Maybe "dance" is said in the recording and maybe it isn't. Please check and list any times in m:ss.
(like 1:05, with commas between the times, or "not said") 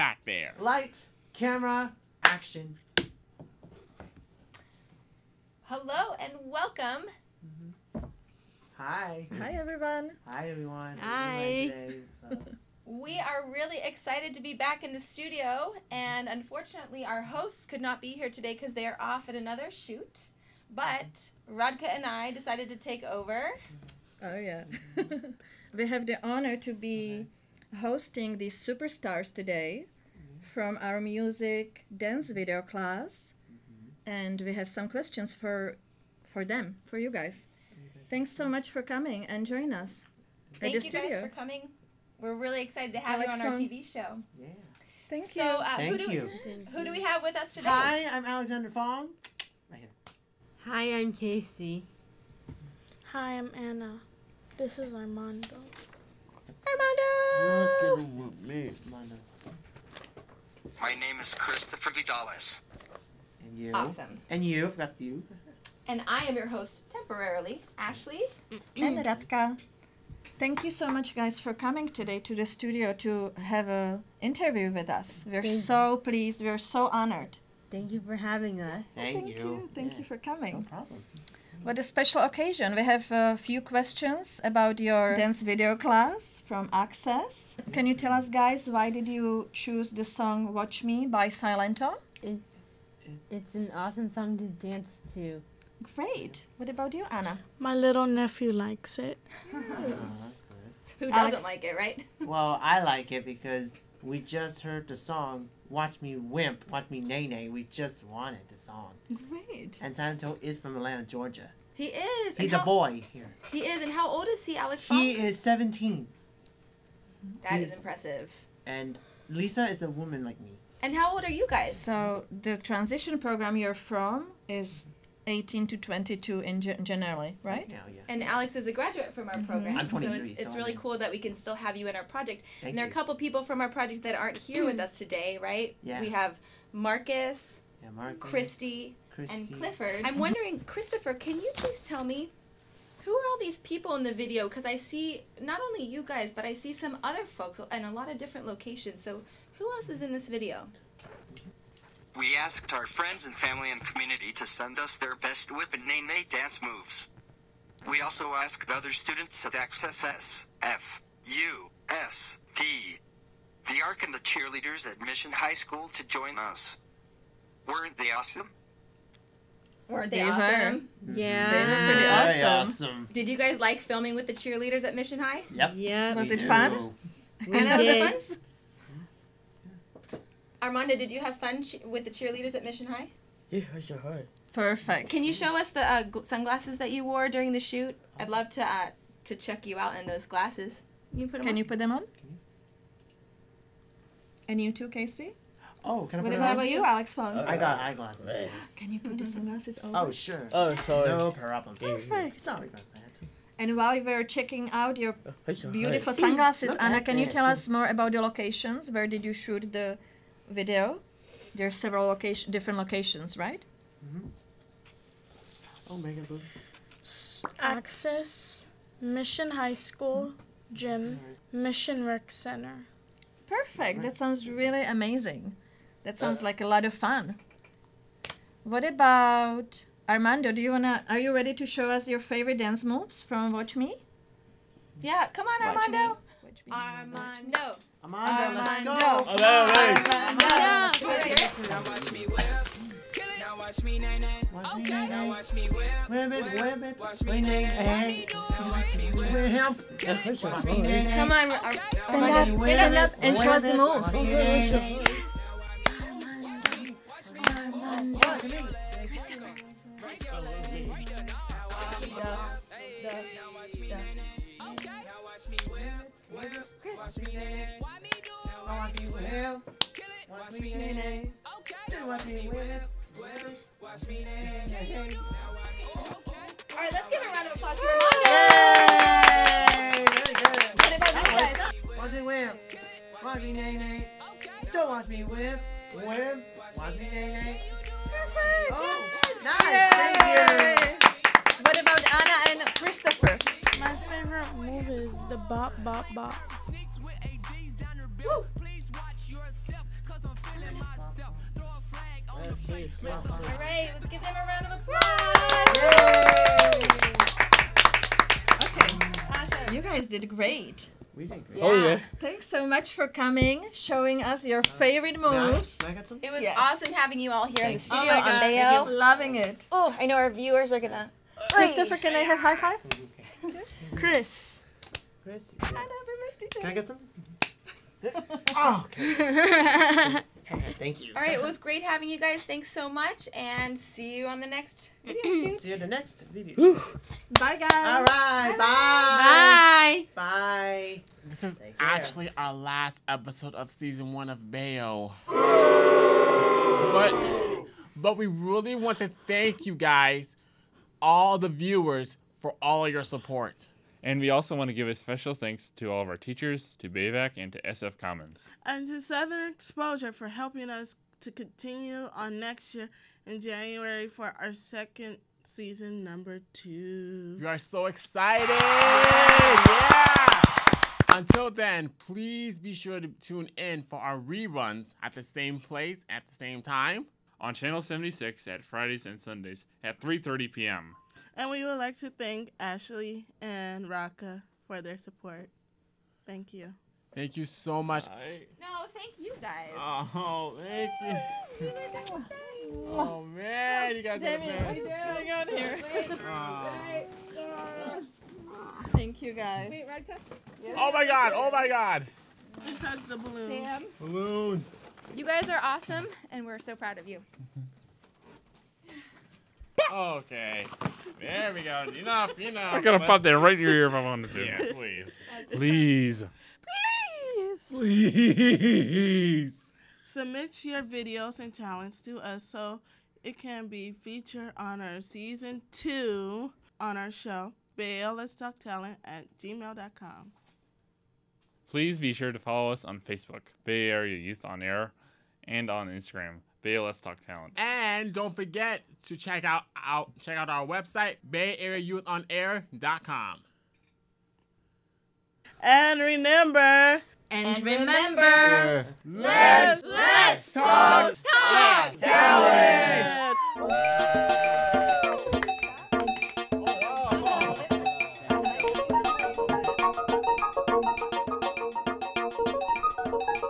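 0:31, 1:25, 1:34, 2:36, 3:52.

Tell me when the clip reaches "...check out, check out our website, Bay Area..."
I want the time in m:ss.
7:19.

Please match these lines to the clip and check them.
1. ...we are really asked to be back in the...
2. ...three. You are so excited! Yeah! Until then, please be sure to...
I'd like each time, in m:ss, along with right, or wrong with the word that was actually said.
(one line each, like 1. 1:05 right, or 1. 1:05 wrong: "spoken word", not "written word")
1. 0:12 wrong: "excited", not "asked"
2. 6:06 wrong: "two", not "three".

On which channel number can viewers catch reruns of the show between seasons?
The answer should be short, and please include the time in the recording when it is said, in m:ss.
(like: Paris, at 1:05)
76, at 6:17.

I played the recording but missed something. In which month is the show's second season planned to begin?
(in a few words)
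January.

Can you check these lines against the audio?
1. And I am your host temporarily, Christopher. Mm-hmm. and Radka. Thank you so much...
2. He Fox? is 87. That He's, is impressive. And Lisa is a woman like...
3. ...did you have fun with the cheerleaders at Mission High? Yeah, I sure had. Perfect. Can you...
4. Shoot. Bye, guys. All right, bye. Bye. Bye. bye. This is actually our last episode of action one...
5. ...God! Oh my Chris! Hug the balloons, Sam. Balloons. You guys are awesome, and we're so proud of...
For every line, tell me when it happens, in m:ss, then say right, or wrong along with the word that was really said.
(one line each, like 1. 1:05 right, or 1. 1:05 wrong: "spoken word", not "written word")
1. 1:05 wrong: "Ashley", not "Christopher"
2. 1:54 wrong: "17", not "87"
3. 3:00 right
4. 5:36 wrong: "season", not "action"
5. 6:41 wrong: "God", not "Chris".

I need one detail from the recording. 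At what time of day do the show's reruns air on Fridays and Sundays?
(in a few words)
3:30 p.m.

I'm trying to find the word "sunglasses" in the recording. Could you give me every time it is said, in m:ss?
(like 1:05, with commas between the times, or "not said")
3:06, 3:19, 3:26.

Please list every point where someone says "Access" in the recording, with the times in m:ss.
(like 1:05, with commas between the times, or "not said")
1:26, 2:39, 3:37.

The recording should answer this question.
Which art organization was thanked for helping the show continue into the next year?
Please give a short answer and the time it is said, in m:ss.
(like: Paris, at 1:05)
Southern Exposure, at 5:58.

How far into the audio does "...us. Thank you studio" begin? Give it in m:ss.
0:39.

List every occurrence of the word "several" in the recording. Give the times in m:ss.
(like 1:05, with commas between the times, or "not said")
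3:31.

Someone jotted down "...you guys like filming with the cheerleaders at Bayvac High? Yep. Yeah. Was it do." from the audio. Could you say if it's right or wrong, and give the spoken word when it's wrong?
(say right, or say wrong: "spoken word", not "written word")
wrong: "Mission", not "Bayvac".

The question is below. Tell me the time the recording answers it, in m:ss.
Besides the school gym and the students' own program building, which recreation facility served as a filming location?
3:41.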